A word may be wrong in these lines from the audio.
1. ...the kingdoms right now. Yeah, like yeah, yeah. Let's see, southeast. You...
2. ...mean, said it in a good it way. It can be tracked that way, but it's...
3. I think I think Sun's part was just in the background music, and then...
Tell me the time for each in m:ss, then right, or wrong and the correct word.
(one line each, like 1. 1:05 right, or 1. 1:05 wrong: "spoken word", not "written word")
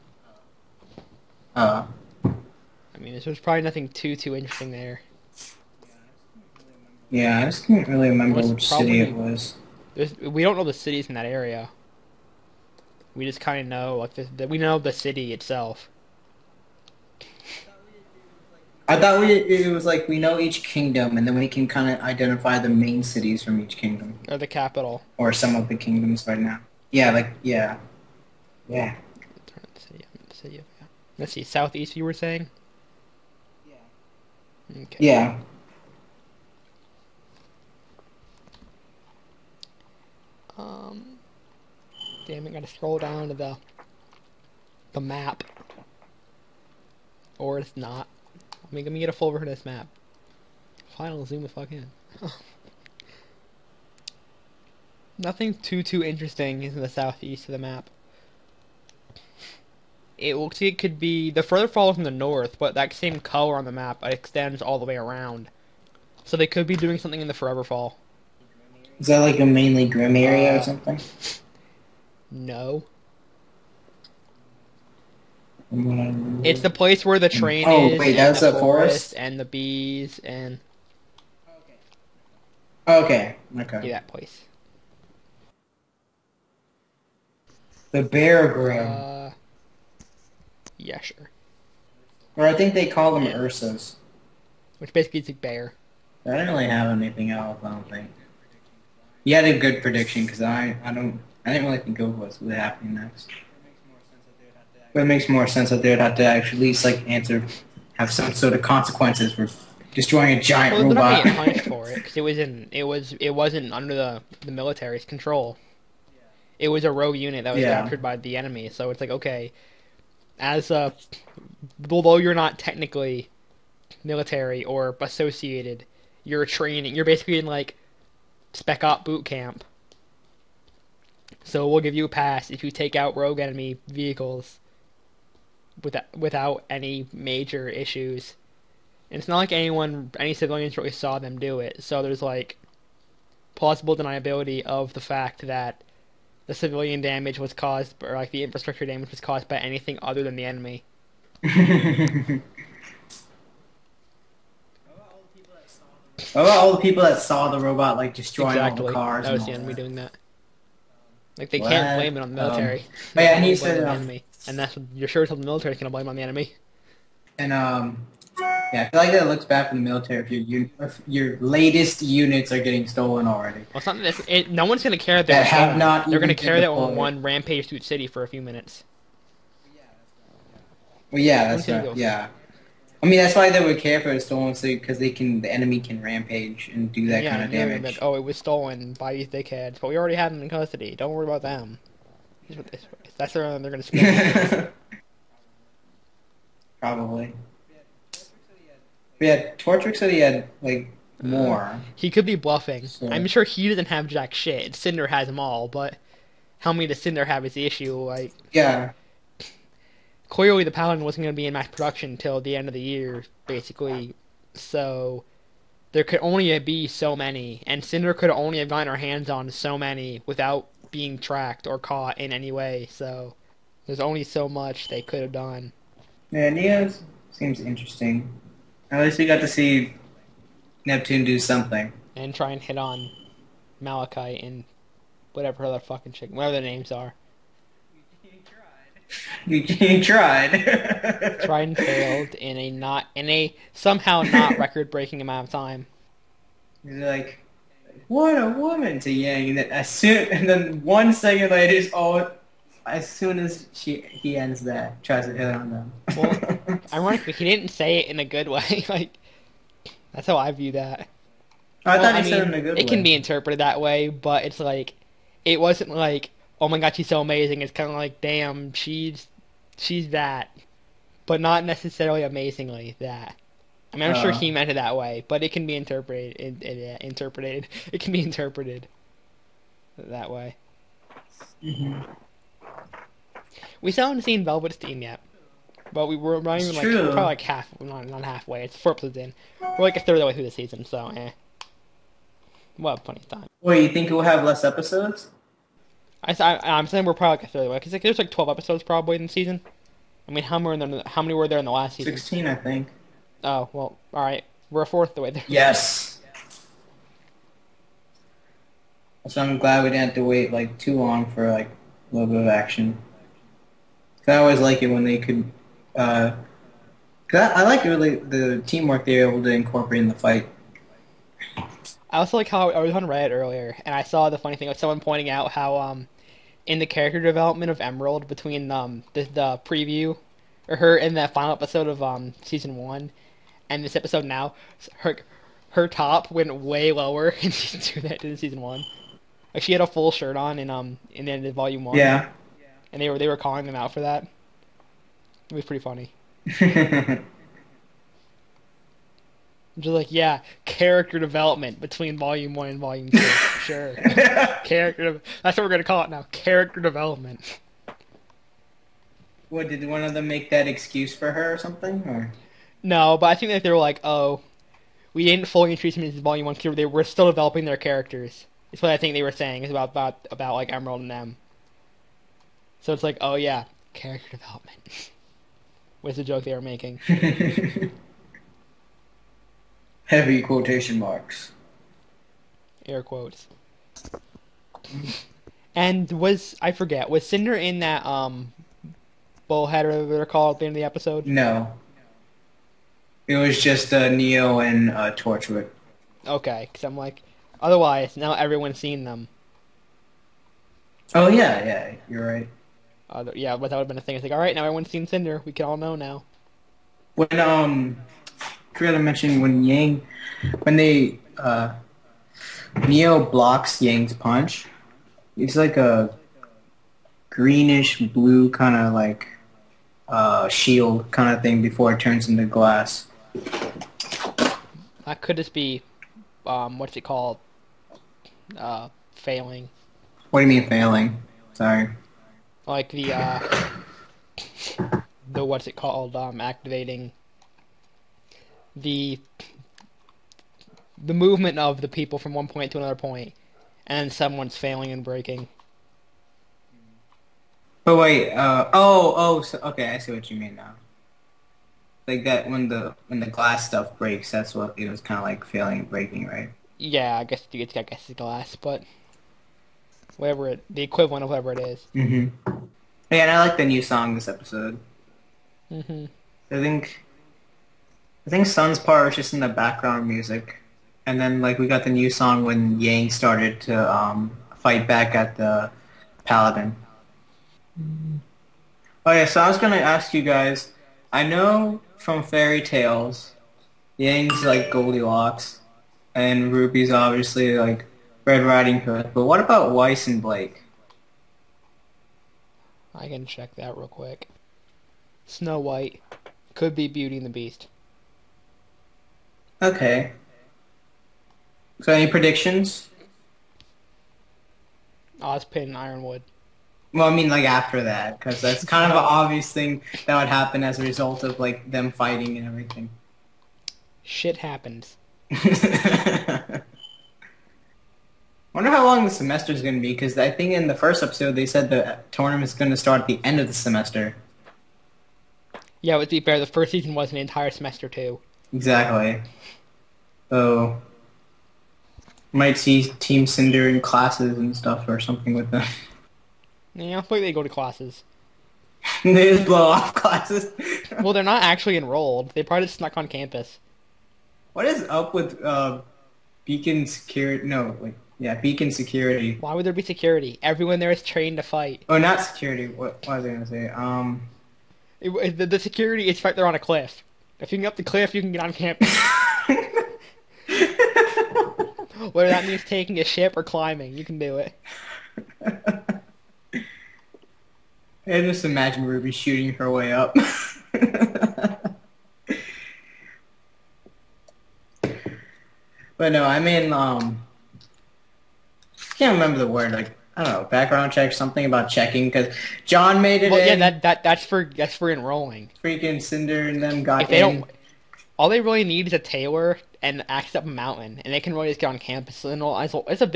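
1. 0:25 right
2. 4:22 wrong: "interpreted", not "tracked"
3. 7:46 right.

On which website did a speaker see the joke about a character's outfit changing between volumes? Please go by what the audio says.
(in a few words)
Reddit.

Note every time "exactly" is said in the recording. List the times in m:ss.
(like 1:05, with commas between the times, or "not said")
2:38, 8:48.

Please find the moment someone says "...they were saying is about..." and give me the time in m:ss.
6:09.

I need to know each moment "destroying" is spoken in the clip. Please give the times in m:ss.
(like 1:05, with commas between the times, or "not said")
1:49, 2:38.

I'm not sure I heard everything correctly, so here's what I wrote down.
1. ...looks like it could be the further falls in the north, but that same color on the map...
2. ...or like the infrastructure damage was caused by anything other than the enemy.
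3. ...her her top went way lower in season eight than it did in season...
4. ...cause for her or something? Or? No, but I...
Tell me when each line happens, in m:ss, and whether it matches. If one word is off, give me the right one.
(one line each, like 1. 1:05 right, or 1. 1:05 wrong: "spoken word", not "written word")
1. 1:00 right
2. 2:28 right
3. 5:34 wrong: "two", not "eight"
4. 6:00 wrong: "excuse", not "cause".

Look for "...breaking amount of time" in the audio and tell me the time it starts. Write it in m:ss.
4:04.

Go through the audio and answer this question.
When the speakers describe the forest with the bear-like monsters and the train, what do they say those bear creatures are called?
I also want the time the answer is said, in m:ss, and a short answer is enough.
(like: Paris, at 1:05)
Ursas, at 1:33.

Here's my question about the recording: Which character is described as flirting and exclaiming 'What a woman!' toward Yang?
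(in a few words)
Neptune.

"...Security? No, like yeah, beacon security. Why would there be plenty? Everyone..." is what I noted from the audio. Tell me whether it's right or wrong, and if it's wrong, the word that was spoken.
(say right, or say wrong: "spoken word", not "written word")
wrong: "security", not "plenty".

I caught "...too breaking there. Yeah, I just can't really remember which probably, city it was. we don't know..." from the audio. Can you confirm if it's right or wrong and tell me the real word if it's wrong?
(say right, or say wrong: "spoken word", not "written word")
wrong: "interesting", not "breaking".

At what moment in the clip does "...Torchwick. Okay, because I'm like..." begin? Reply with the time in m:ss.
6:35.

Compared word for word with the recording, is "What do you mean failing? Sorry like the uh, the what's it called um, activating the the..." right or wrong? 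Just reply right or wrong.
right.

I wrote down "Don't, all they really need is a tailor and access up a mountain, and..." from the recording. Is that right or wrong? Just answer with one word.
right.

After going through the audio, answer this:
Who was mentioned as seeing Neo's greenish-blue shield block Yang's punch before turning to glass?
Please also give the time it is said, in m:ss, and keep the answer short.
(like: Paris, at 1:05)
Kriya, at 6:48.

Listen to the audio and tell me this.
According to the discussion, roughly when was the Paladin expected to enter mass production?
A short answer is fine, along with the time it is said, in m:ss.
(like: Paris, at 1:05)
End of the year, at 3:32.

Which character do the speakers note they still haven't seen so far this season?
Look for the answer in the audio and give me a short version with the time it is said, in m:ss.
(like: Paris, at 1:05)
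Velvet, at 4:44.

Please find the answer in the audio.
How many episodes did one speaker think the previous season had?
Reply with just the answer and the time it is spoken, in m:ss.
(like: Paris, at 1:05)
16, at 5:02.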